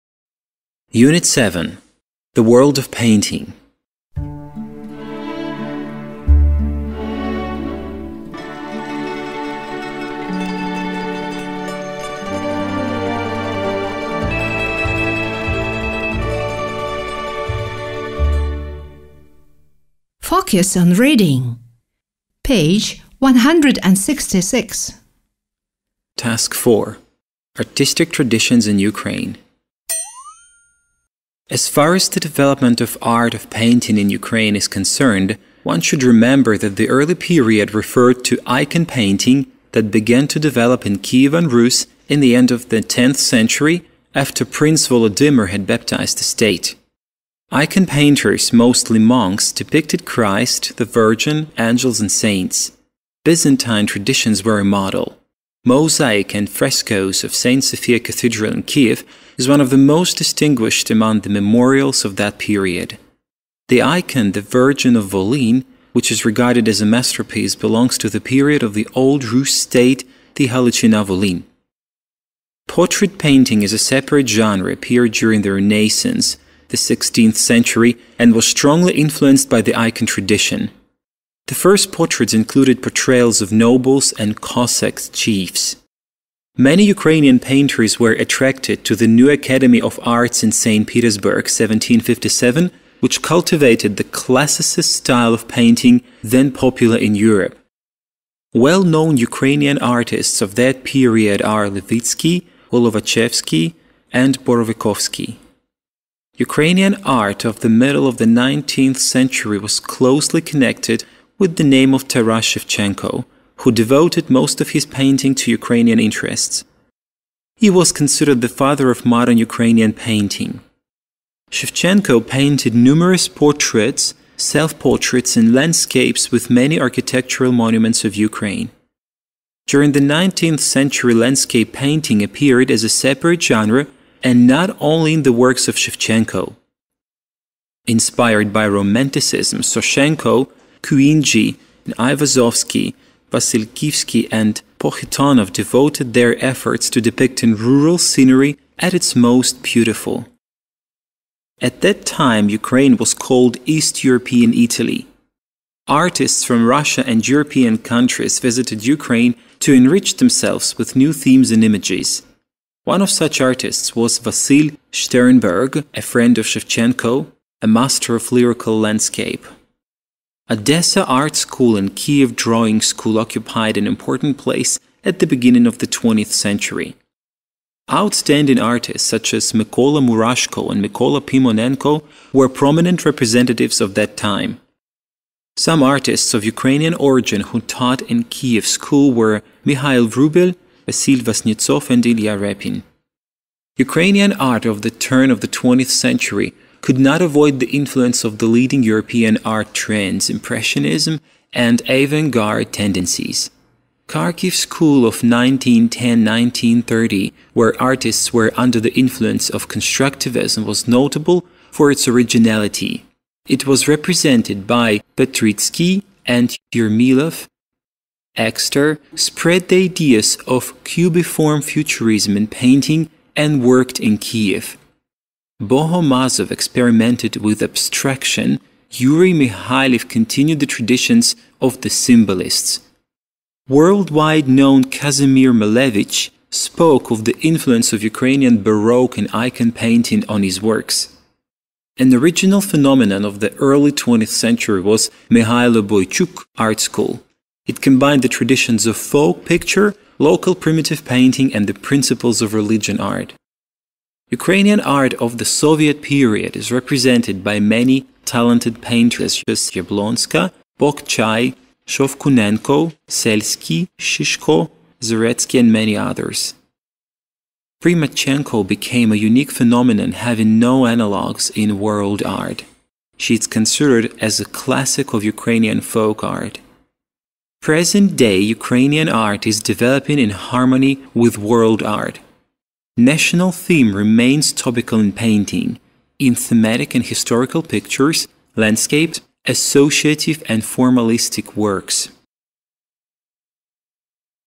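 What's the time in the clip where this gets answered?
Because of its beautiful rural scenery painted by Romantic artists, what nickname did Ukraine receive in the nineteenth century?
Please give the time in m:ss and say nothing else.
2:33.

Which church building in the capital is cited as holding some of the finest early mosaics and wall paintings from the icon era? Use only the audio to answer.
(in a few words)
St. Sophia Cathedral.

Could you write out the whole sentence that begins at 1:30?
Petersburg, 1757, which cultivated the classicist style of painting then popular in Europe.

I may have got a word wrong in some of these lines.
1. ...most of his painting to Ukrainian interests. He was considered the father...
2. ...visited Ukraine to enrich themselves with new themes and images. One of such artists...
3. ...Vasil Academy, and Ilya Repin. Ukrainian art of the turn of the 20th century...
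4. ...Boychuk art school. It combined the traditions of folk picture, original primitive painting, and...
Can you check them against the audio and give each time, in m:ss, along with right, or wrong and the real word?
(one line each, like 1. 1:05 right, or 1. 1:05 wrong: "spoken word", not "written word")
1. 1:54 right
2. 2:38 right
3. 3:10 wrong: "Vasnetsov", not "Academy"
4. 4:05 wrong: "local", not "original".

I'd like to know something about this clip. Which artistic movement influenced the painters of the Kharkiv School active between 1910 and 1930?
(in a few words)
Constructivism.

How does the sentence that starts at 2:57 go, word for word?
Outstanding artists such as Mikola Murashko and Mikola Pimonenko were prominent representatives of that time.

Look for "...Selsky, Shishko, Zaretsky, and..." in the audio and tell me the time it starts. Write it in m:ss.
4:23.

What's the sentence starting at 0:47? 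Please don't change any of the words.
Icon painters, mostly monks, depicted Christ, the Virgin, angels, and saints.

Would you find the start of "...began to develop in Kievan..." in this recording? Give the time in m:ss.
0:39.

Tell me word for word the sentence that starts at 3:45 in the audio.
Bohomazov experimented with abstraction, Yuri Mikhailov continued the traditions of the symbolists.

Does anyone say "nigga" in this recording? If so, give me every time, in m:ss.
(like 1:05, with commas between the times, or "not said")
not said.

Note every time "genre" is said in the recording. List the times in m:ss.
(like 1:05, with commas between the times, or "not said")
1:14, 2:13.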